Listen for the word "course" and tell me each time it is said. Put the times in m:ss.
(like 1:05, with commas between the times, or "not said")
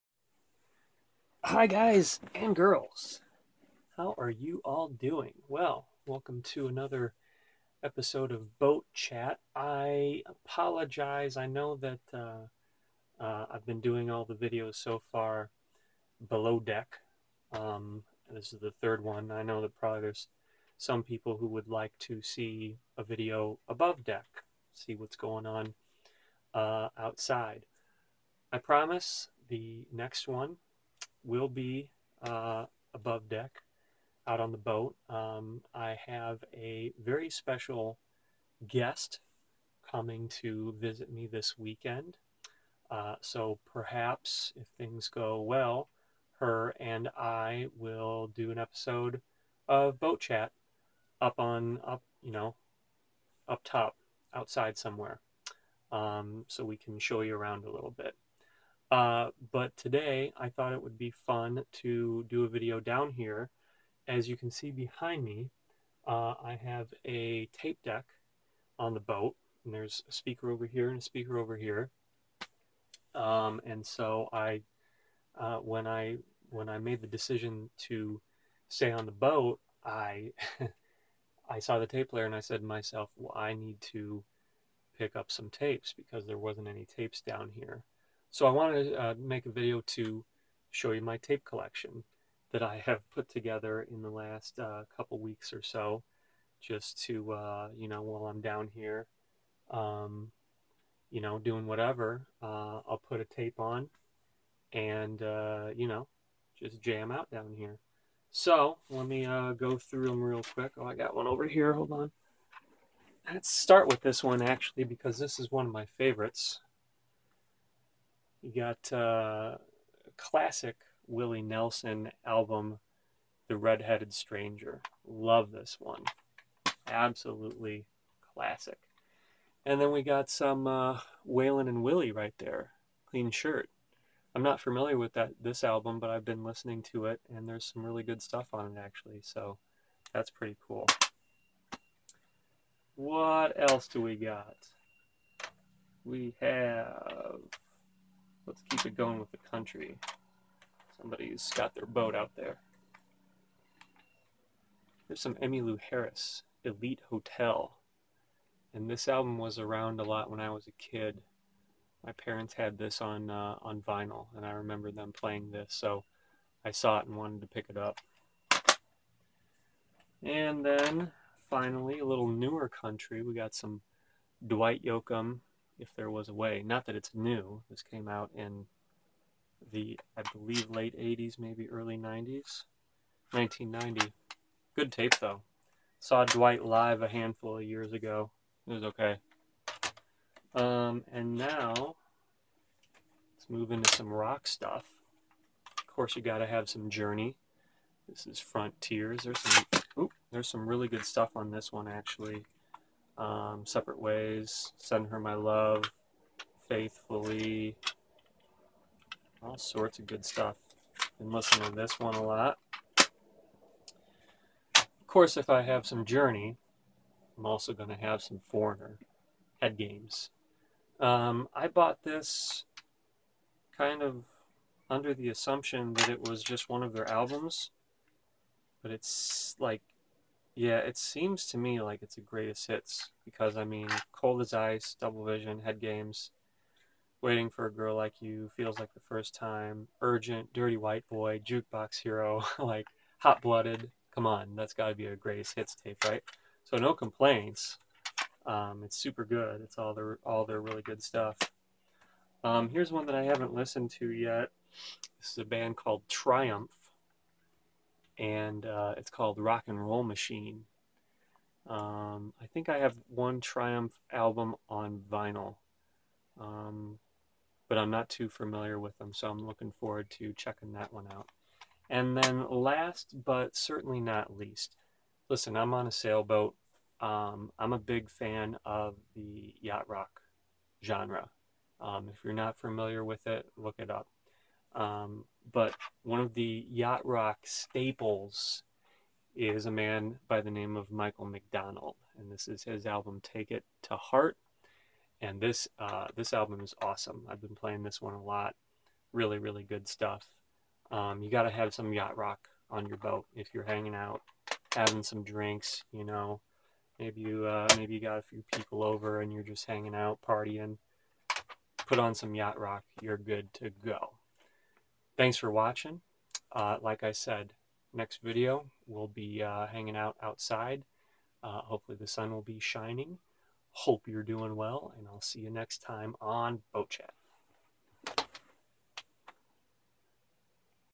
3:15, 3:35.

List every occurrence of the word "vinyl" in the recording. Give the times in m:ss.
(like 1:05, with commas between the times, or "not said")
2:43, 4:25.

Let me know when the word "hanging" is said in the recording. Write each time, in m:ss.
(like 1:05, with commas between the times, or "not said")
5:03, 5:09, 5:19.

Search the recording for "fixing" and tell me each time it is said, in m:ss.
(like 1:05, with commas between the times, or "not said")
not said.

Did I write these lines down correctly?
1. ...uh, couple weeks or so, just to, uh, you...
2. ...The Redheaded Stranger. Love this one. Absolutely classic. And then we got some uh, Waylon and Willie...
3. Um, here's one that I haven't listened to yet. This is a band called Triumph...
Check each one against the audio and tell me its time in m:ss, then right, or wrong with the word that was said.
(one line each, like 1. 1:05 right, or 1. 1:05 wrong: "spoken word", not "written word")
1. 1:34 right
2. 2:03 right
3. 4:12 right.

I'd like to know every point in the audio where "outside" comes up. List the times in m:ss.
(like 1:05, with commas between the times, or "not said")
0:26, 0:54, 5:20.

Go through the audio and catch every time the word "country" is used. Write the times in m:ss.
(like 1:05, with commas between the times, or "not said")
2:29, 2:52.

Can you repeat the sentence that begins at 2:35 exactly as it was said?
There's some Emmylou Harris, Elite Hotel.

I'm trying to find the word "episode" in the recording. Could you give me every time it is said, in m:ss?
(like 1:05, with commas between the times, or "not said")
0:07, 0:48.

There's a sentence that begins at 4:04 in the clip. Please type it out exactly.
Come on, that's got to be a greatest hits tape, right?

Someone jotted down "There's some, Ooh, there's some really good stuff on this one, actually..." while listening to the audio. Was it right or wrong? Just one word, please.
right.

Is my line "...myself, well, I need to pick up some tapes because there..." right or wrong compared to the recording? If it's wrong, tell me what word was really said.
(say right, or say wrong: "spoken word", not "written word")
right.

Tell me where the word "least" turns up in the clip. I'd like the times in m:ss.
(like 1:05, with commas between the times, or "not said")
4:34.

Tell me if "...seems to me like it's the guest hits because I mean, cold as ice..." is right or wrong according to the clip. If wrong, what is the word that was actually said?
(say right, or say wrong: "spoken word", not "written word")
wrong: "greatest", not "guest".